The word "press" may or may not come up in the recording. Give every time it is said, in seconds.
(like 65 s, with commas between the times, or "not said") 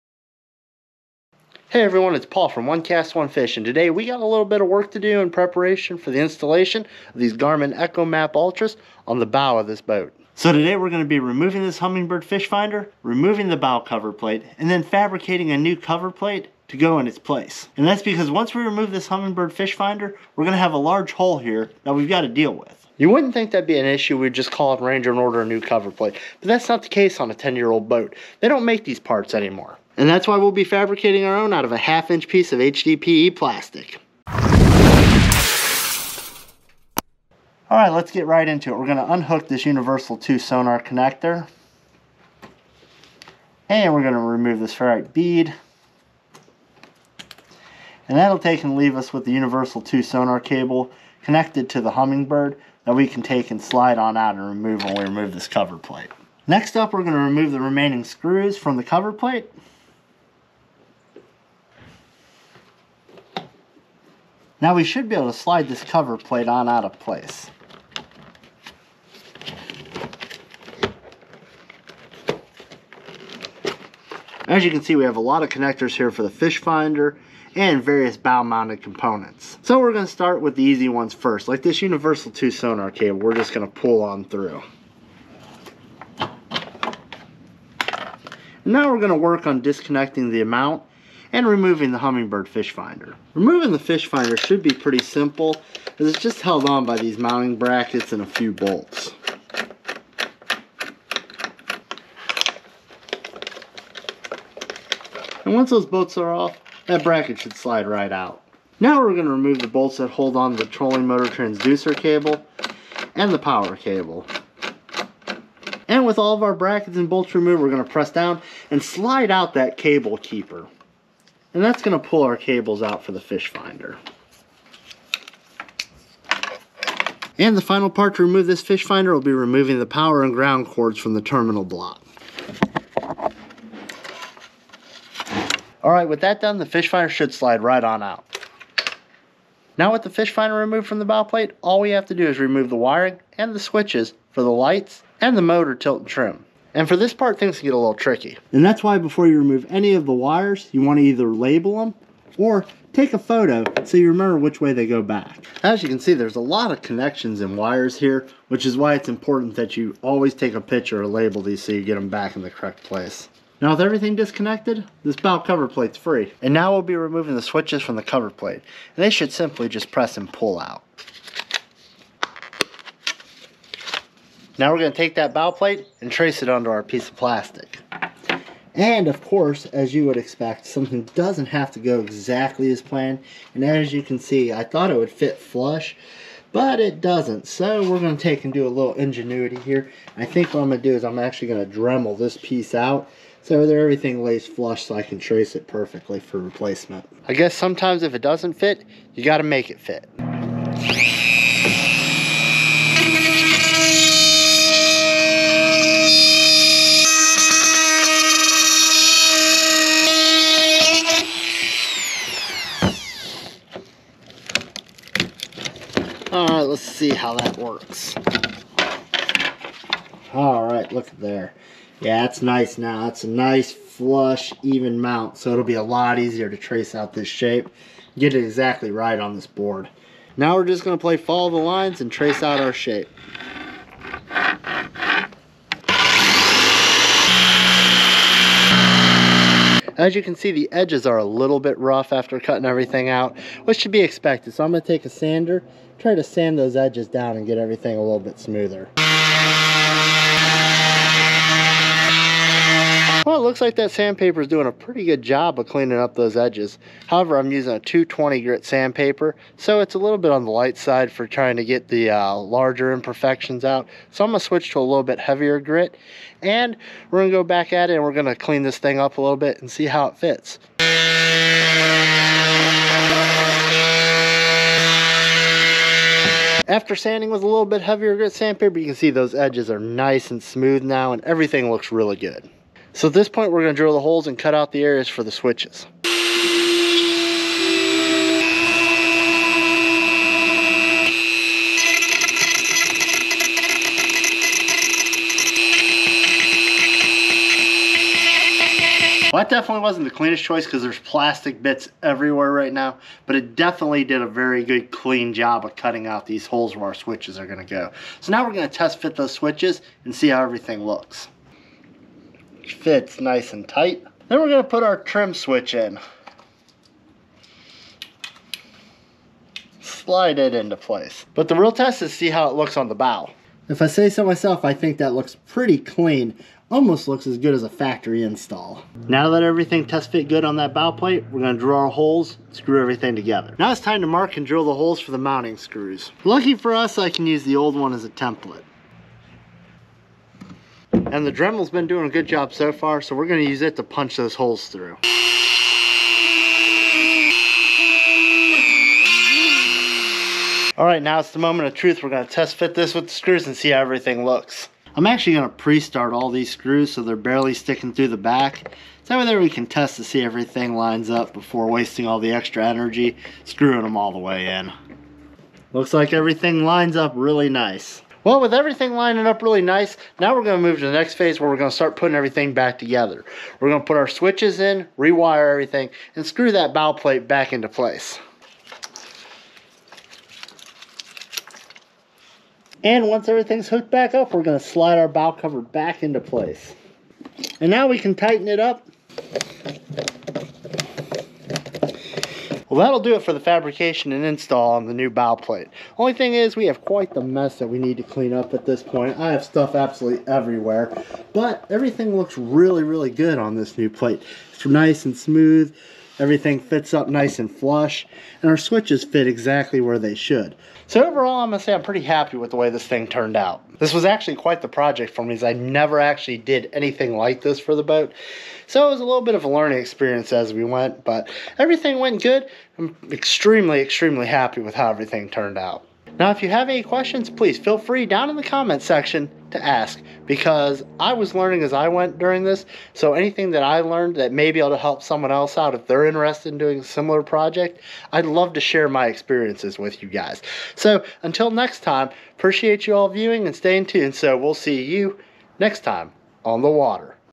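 117 s, 169 s.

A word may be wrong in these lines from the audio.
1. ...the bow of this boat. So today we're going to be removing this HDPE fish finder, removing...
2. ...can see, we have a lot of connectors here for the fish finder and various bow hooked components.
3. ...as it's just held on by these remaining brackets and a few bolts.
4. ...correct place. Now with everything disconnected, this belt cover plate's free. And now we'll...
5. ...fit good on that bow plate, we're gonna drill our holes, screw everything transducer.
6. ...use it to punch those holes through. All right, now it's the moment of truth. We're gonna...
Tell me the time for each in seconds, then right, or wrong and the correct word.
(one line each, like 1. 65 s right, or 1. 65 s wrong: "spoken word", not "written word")
1. 9 s wrong: "Humminbird", not "HDPE"
2. 74 s wrong: "mounted", not "hooked"
3. 95 s wrong: "mounting", not "remaining"
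4. 162 s right
5. 330 s wrong: "together", not "transducer"
6. 343 s right.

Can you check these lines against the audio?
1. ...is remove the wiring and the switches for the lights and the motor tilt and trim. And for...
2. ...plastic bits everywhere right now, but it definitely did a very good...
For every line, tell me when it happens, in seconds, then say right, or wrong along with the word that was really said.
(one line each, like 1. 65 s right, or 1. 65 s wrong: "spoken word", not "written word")
1. 142 s right
2. 300 s right.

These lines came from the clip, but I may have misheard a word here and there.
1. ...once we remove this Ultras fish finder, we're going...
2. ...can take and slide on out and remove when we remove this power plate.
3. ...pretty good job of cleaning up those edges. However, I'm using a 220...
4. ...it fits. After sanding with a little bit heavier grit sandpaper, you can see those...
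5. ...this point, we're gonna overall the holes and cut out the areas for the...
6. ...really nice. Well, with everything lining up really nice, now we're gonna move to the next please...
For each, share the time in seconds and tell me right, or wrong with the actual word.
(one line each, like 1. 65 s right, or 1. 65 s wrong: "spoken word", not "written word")
1. 18 s wrong: "Humminbird", not "Ultras"
2. 53 s wrong: "cover", not "power"
3. 254 s right
4. 270 s right
5. 283 s wrong: "drill", not "overall"
6. 367 s wrong: "phase", not "please".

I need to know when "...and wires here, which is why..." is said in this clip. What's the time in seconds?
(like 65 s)
157 s.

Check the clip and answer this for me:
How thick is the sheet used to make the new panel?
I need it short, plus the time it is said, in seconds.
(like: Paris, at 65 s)
half inch, at 31 s.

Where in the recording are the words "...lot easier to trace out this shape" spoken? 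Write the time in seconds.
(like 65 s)
225 s.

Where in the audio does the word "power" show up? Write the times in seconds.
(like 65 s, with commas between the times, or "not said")
113 s, 129 s.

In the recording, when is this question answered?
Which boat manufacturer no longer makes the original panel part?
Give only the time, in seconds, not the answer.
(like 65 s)
24 s.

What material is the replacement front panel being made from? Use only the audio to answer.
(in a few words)
HDPE plastic.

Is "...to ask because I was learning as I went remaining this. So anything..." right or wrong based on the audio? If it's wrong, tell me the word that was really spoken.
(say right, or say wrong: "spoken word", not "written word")
wrong: "during", not "remaining".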